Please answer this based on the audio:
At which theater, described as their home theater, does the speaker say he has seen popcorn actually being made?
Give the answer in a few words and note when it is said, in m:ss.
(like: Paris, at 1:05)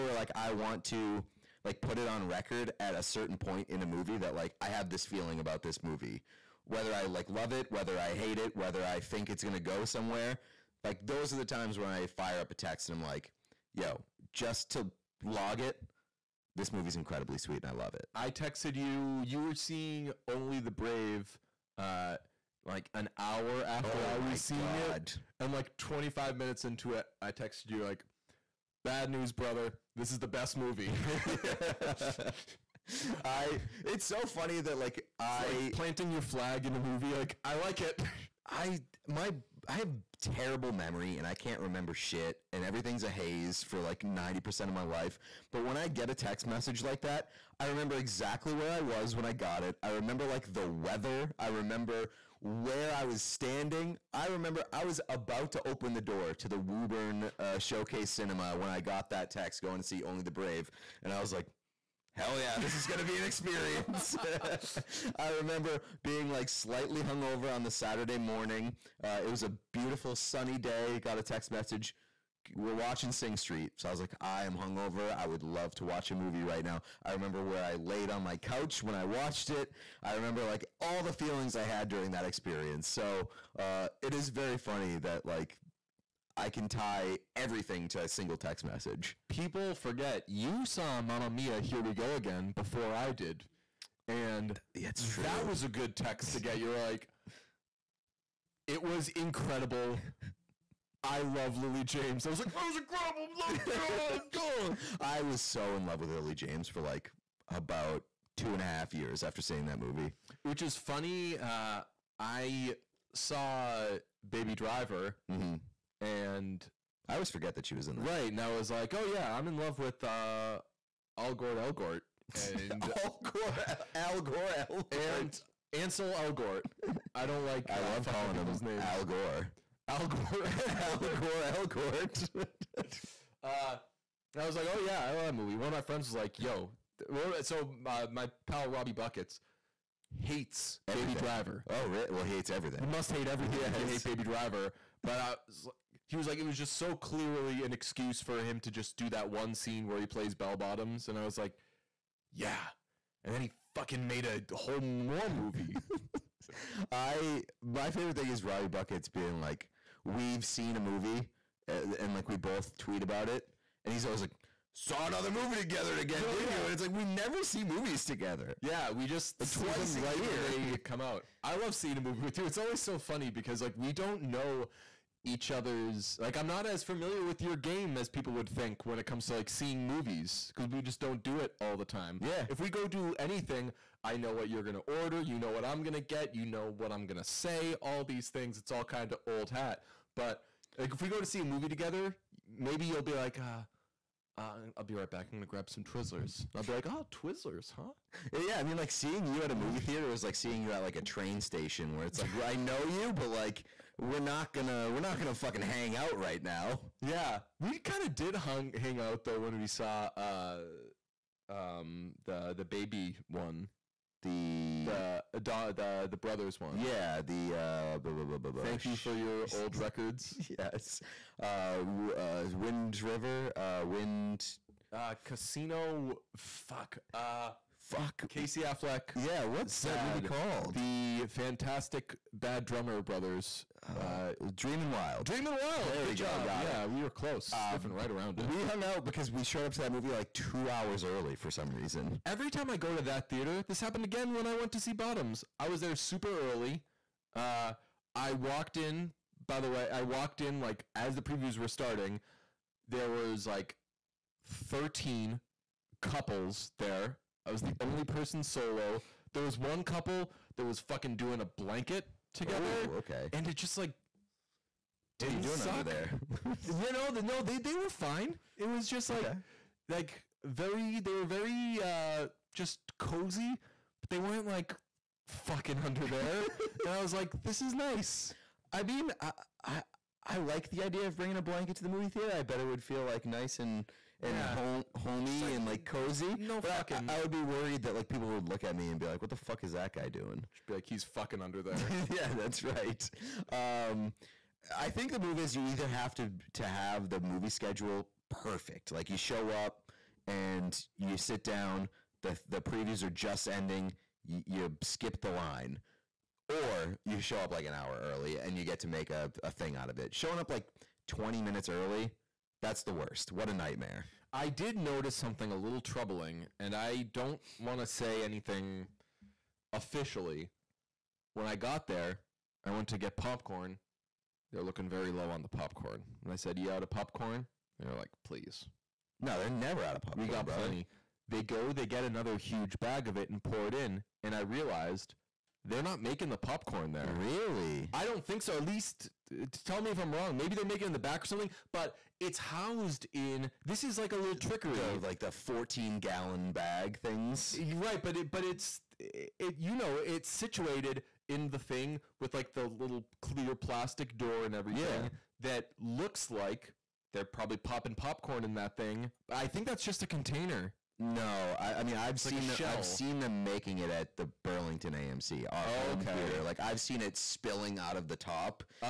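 Burlington AMC, at 6:04.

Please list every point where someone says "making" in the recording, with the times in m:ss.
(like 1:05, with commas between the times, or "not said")
5:36, 5:40, 6:03.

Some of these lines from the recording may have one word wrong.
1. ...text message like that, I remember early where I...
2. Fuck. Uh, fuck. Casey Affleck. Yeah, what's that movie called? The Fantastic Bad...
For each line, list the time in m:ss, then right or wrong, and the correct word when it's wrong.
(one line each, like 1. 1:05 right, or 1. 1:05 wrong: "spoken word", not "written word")
1. 0:46 wrong: "exactly", not "early"
2. 3:46 right.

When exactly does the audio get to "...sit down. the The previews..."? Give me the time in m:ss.
5:01.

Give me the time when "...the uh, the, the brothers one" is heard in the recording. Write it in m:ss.
3:35.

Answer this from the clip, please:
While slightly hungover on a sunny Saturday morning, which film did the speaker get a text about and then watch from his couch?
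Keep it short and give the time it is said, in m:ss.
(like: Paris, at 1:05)
Sing Street, at 1:13.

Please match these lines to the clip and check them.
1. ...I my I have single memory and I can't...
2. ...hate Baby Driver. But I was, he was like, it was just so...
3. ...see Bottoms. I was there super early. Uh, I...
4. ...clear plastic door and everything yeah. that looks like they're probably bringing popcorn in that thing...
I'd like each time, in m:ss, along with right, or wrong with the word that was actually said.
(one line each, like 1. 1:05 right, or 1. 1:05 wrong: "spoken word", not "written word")
1. 0:38 wrong: "terrible", not "single"
2. 2:23 right
3. 4:04 right
4. 5:53 wrong: "popping", not "bringing".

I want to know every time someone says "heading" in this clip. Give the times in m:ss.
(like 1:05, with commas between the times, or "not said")
not said.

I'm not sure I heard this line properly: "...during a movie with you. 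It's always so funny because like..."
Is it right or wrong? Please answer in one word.
wrong.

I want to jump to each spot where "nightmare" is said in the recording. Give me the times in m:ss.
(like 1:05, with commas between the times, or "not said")
5:13.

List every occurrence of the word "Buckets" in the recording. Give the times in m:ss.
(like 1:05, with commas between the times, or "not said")
2:18, 2:38.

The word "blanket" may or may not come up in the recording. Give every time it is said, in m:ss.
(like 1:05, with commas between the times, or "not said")
4:21, 4:41.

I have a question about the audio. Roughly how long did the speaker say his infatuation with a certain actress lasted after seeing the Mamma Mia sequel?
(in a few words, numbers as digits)
2 and a half years.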